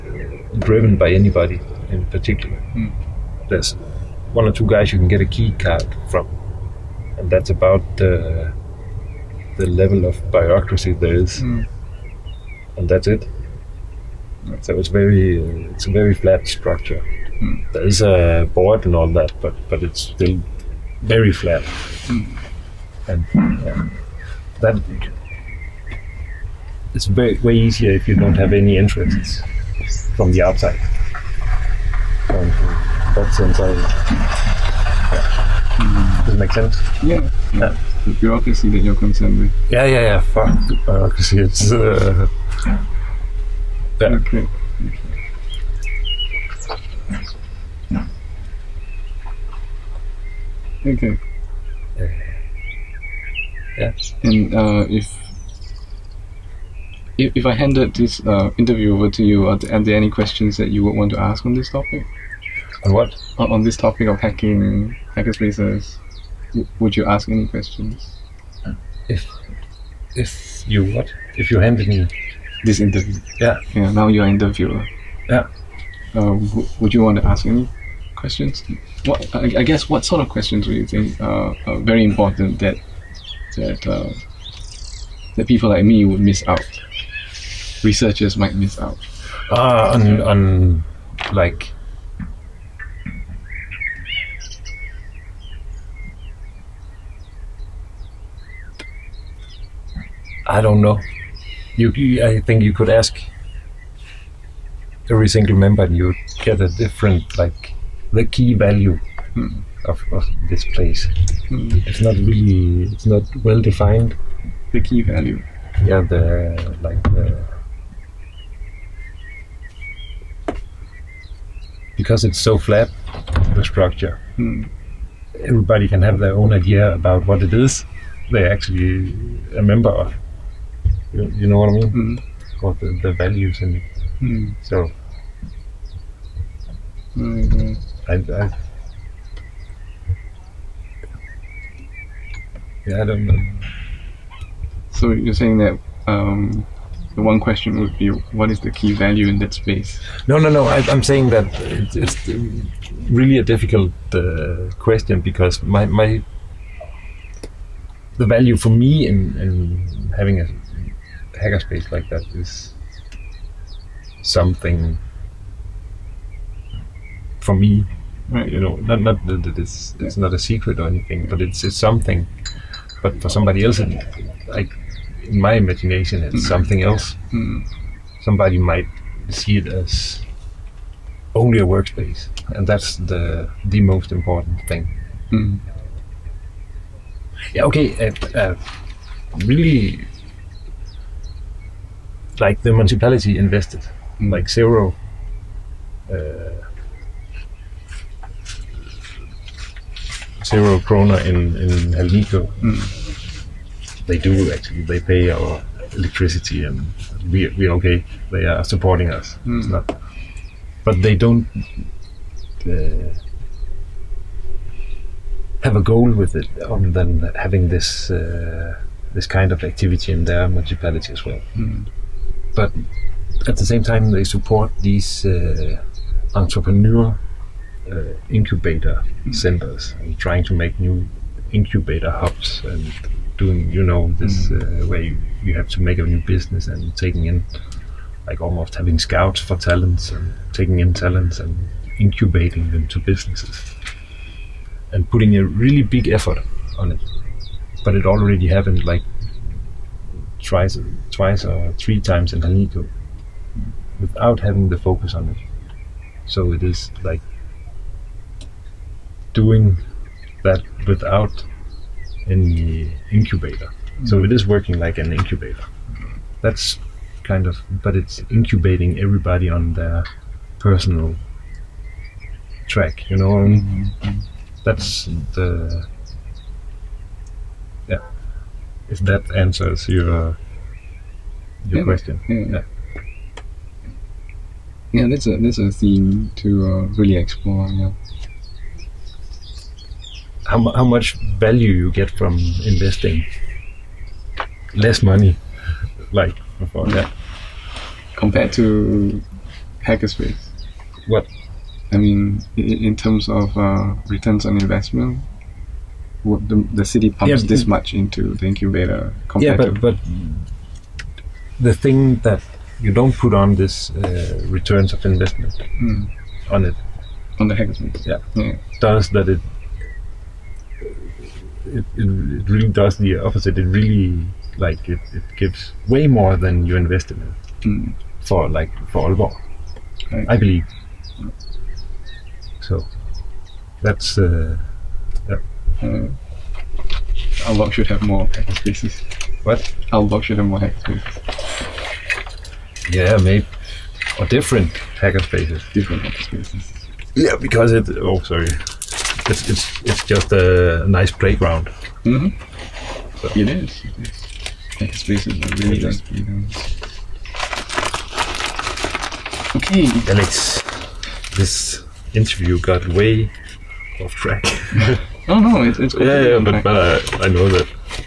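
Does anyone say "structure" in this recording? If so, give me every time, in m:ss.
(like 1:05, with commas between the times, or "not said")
0:16, 2:03.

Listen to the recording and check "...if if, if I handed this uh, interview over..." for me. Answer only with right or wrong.
right.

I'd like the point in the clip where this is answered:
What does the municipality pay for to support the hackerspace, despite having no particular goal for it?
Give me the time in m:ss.
3:25.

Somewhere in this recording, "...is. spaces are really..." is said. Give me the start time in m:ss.
5:54.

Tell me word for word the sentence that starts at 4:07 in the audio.
But it already happened like twice, twice or three times in Hal9K without having the focus on it.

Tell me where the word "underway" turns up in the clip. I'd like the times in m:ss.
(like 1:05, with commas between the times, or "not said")
not said.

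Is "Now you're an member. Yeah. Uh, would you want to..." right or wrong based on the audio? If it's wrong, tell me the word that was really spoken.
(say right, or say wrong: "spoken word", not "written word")
wrong: "interviewer", not "member".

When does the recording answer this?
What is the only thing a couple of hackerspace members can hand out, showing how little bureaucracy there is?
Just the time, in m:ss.
0:05.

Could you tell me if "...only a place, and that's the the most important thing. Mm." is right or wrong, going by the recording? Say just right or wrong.
wrong.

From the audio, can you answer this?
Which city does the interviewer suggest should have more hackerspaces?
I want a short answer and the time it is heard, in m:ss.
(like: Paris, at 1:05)
Aalborg, at 5:39.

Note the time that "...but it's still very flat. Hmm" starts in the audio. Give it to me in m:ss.
0:19.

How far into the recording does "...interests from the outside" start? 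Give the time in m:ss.
0:28.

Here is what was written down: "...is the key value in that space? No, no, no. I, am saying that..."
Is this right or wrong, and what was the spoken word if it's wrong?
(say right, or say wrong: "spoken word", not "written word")
right.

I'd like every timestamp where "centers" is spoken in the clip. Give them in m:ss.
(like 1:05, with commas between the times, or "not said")
3:49.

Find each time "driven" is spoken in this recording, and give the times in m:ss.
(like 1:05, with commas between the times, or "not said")
0:00.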